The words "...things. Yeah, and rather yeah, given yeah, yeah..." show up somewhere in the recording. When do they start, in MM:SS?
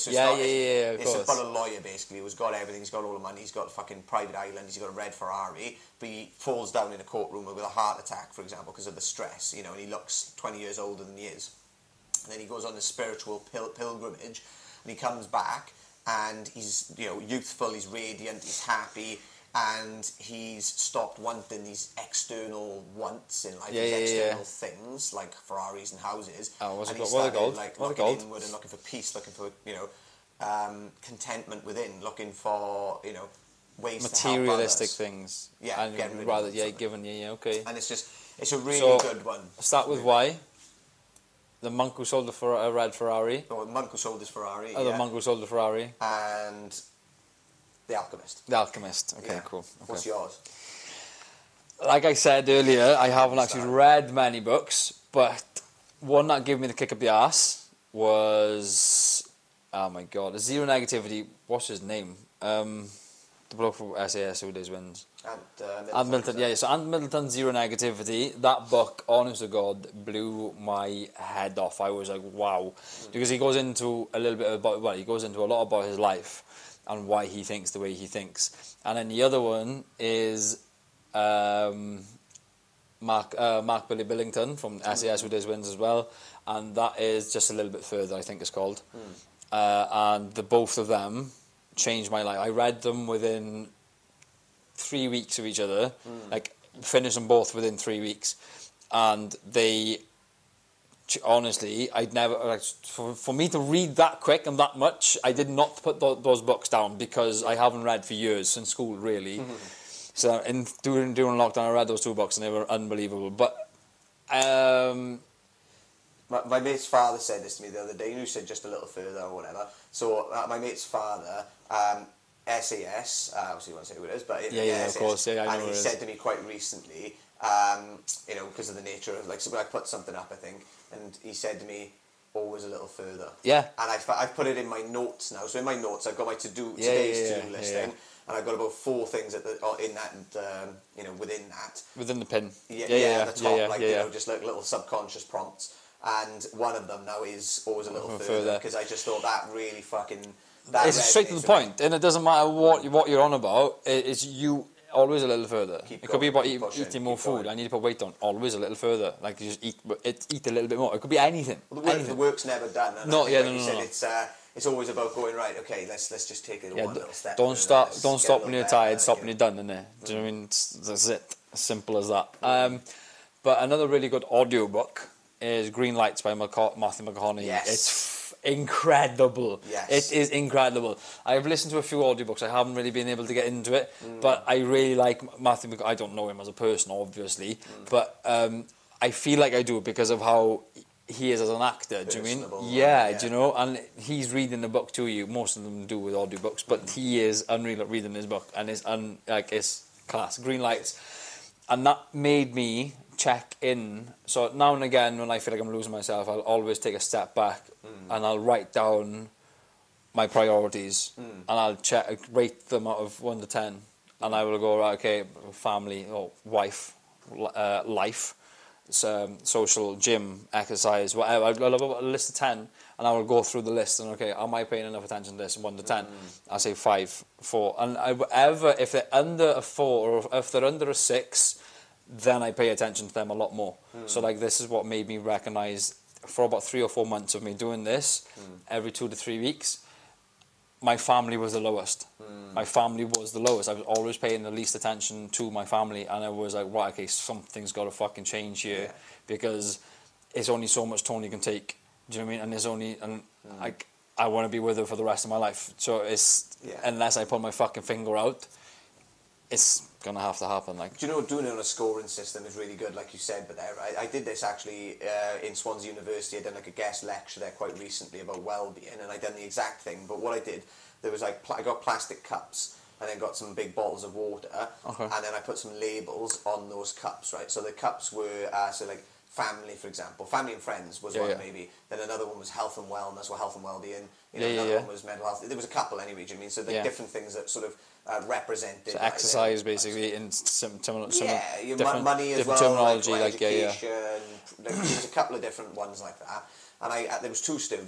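00:34.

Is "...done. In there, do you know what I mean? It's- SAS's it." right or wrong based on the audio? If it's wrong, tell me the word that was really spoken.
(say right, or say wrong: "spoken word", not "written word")
wrong: "That", not "SAS".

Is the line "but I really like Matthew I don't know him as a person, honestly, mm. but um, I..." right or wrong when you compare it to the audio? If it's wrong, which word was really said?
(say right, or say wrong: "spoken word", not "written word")
wrong: "obviously", not "honestly".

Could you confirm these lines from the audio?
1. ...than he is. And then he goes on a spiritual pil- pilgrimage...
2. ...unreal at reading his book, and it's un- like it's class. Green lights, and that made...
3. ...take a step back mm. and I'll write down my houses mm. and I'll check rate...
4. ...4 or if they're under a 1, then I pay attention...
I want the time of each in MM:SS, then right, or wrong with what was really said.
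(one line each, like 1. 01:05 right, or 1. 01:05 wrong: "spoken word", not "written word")
1. 00:11 right
2. 03:17 right
3. 03:26 wrong: "priorities", not "houses"
4. 03:49 wrong: "6", not "1".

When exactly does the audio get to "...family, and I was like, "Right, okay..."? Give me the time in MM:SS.
04:05.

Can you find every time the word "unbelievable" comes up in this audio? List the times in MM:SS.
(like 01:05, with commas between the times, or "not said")
01:52.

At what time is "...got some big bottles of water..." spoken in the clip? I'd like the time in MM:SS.
04:33.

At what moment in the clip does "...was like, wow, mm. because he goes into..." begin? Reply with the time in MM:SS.
01:11.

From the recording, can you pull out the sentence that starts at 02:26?
And one of them now is always a little further because I just thought that really fucking.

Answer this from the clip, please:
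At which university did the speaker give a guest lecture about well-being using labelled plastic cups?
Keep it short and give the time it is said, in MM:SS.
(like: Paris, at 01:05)
Swansea University, at 04:25.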